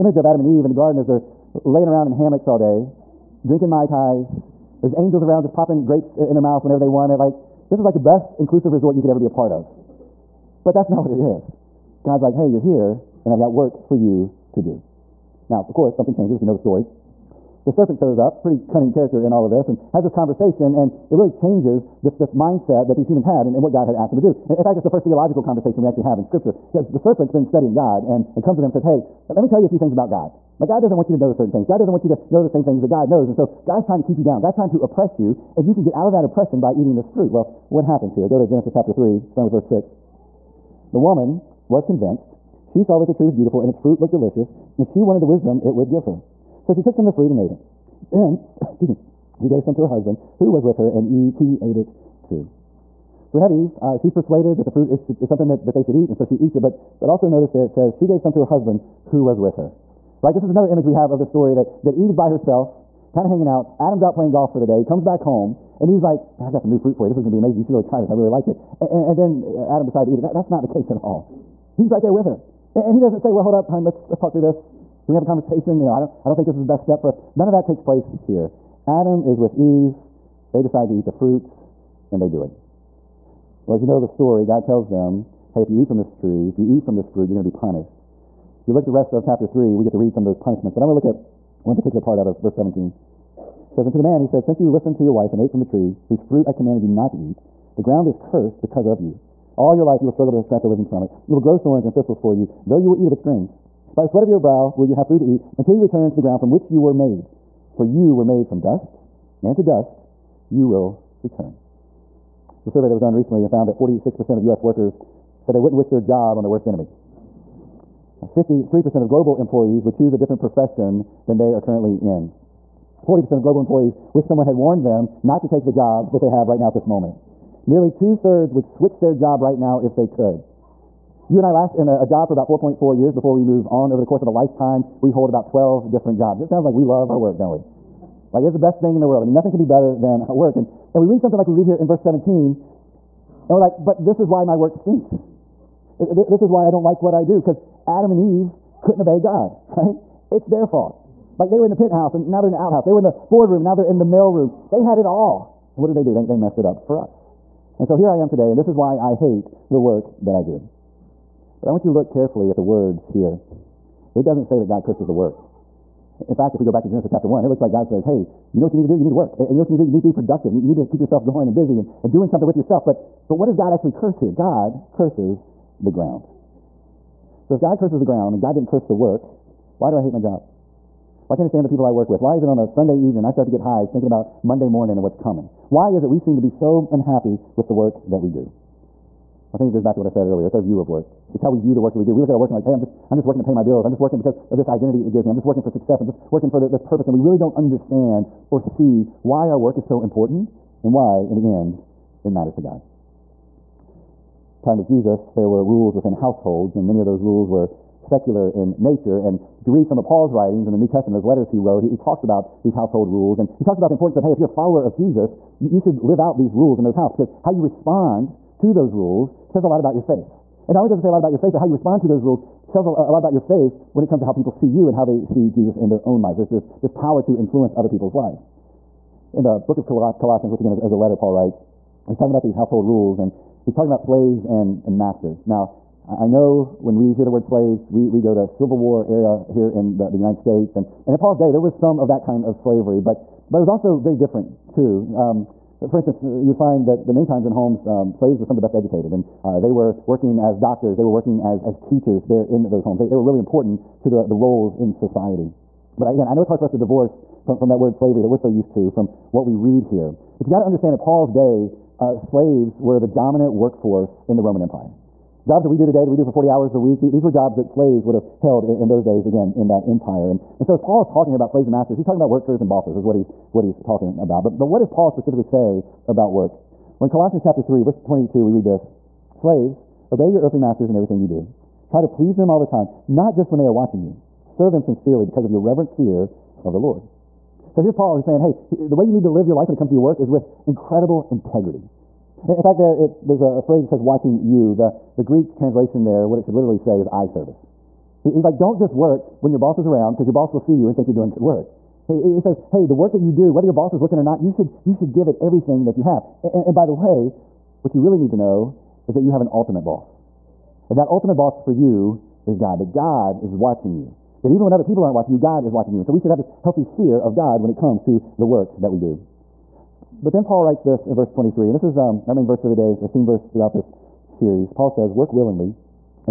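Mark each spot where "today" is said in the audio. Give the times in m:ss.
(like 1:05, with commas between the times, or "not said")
2:38, 4:25.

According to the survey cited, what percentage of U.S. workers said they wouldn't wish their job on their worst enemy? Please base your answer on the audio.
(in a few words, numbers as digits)
46%.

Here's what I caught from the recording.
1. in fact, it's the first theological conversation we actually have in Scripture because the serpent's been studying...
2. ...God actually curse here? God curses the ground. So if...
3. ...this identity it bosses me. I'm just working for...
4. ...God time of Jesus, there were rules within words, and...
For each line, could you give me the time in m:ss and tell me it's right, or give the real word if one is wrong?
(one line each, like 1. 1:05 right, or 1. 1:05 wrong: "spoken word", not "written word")
1. 0:24 right
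2. 2:53 right
3. 3:14 wrong: "gives", not "bosses"
4. 3:22 wrong: "households", not "words".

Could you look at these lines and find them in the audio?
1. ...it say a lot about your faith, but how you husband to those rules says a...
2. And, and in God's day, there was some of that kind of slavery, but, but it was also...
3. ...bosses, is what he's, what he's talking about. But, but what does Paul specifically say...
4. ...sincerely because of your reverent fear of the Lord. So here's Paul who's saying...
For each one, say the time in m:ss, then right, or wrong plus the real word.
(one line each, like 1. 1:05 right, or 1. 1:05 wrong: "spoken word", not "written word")
1. 3:40 wrong: "respond", not "husband"
2. 4:00 wrong: "Paul", not "God"
3. 4:32 right
4. 4:44 right.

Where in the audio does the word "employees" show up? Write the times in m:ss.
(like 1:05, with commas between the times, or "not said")
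1:59, 2:03.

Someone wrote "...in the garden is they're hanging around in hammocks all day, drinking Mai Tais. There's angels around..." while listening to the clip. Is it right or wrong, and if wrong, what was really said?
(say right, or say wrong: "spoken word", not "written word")
wrong: "laying", not "hanging".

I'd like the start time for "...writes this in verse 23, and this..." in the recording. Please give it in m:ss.
5:20.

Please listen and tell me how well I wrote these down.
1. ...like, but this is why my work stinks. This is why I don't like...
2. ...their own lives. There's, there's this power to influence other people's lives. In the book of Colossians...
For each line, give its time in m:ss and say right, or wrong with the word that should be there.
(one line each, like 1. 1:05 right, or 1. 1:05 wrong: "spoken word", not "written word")
1. 2:23 right
2. 3:45 right.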